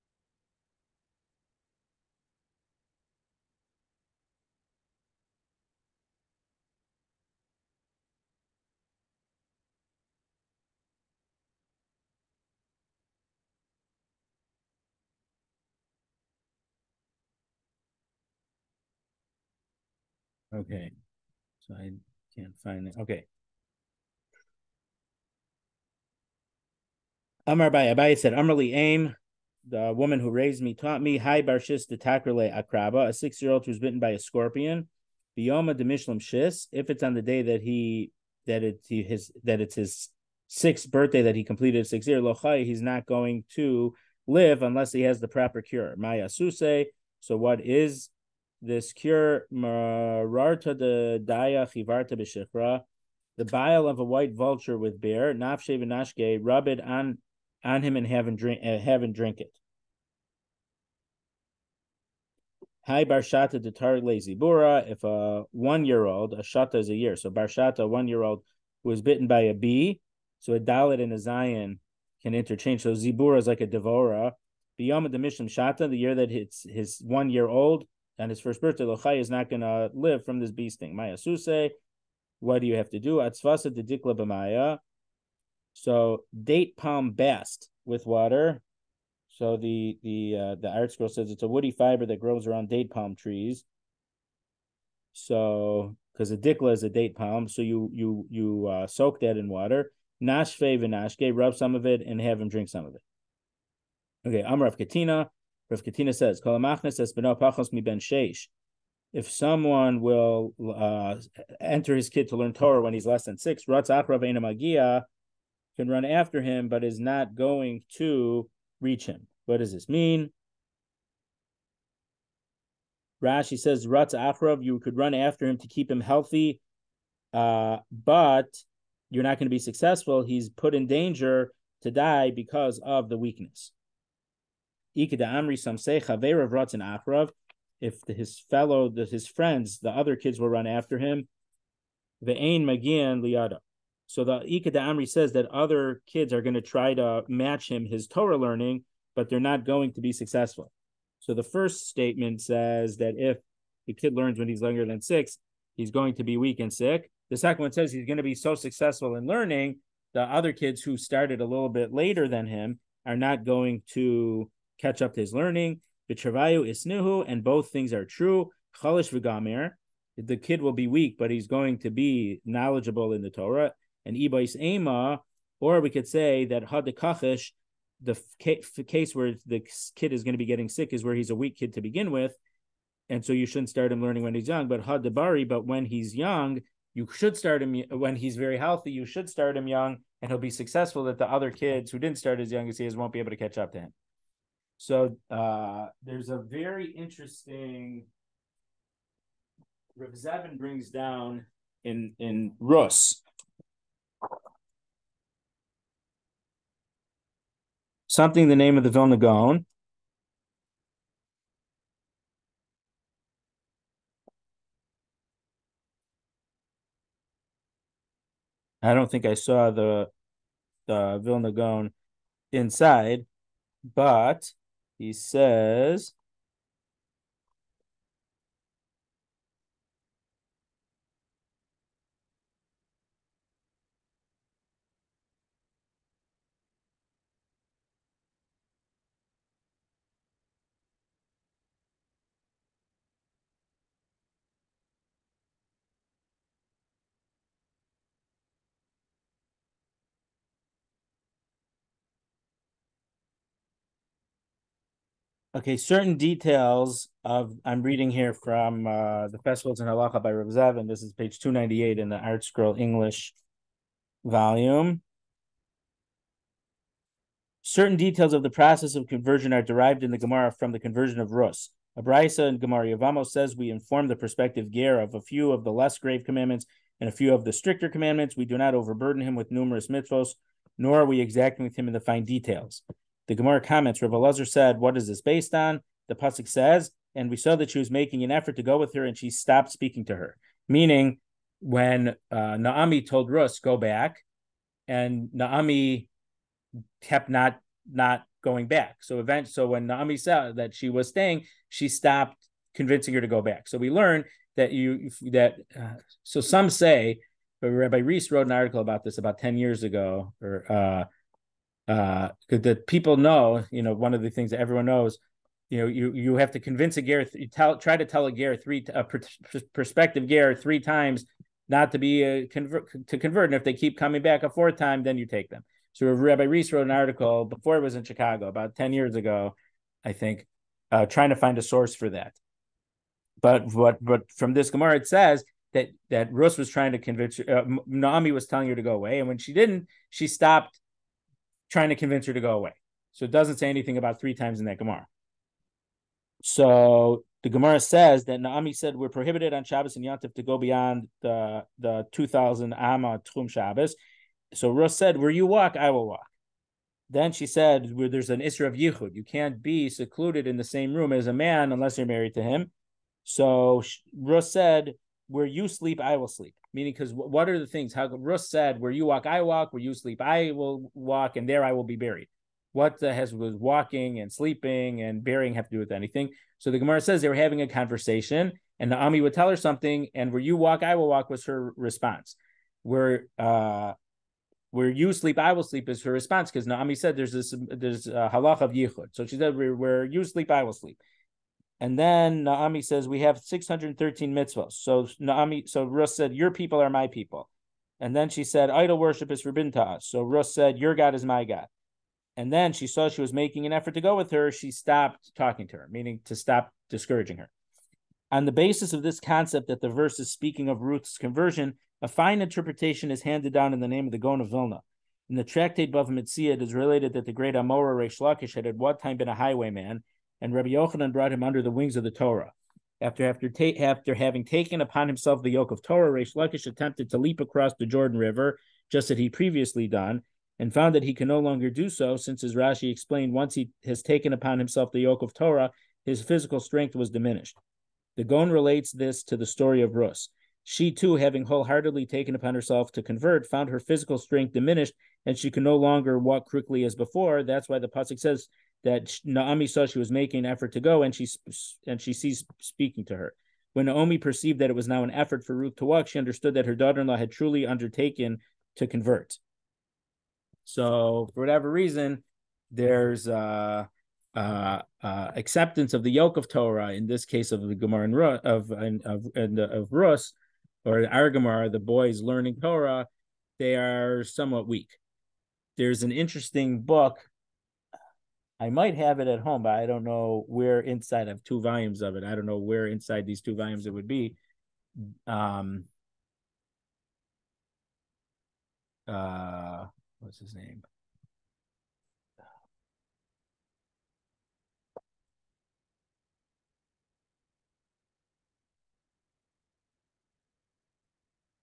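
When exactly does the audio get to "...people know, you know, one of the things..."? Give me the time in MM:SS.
05:12.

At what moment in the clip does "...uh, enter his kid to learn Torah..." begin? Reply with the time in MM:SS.
01:50.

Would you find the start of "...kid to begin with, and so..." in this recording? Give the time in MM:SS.
03:01.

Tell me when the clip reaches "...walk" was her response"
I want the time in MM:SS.
06:21.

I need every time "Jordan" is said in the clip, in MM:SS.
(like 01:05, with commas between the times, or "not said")
07:07.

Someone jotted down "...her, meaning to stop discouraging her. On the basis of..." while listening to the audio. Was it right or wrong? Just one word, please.
right.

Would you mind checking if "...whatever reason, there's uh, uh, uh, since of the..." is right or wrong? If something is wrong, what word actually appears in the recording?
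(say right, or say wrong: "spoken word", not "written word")
wrong: "acceptance", not "since".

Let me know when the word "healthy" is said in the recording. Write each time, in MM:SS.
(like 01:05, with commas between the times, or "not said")
02:05, 03:08.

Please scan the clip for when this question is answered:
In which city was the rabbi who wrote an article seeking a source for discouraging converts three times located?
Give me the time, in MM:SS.
05:28.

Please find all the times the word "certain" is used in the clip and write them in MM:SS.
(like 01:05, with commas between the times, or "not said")
04:15, 04:27.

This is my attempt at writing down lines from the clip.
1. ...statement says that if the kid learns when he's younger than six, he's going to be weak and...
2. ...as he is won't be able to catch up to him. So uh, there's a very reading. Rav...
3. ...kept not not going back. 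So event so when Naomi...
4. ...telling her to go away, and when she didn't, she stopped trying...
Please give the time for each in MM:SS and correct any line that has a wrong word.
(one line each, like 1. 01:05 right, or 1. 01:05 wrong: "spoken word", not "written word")
1. 02:31 right
2. 03:12 wrong: "interesting", not "reading"
3. 04:56 right
4. 05:38 right.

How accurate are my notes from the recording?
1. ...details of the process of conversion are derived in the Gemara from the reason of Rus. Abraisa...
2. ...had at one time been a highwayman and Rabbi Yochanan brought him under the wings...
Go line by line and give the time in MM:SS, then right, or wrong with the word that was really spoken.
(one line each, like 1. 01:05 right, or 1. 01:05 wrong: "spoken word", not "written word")
1. 04:27 wrong: "conversion", not "reason"
2. 06:58 right.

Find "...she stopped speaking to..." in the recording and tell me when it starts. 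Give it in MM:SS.
04:49.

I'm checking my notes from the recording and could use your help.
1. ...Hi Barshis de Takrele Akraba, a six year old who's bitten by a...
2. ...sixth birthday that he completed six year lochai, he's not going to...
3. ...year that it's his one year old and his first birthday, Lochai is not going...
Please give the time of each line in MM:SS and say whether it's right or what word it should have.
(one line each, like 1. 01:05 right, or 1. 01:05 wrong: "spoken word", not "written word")
1. 00:31 right
2. 00:40 right
3. 01:15 right.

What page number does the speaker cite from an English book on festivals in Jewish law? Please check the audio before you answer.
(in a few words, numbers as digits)
298.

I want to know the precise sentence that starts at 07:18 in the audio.
The Gaon relates this to the story of Rus.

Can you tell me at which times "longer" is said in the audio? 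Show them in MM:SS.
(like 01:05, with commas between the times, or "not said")
07:11, 07:25.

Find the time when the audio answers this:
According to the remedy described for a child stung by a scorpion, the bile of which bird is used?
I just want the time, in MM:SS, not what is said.
00:54.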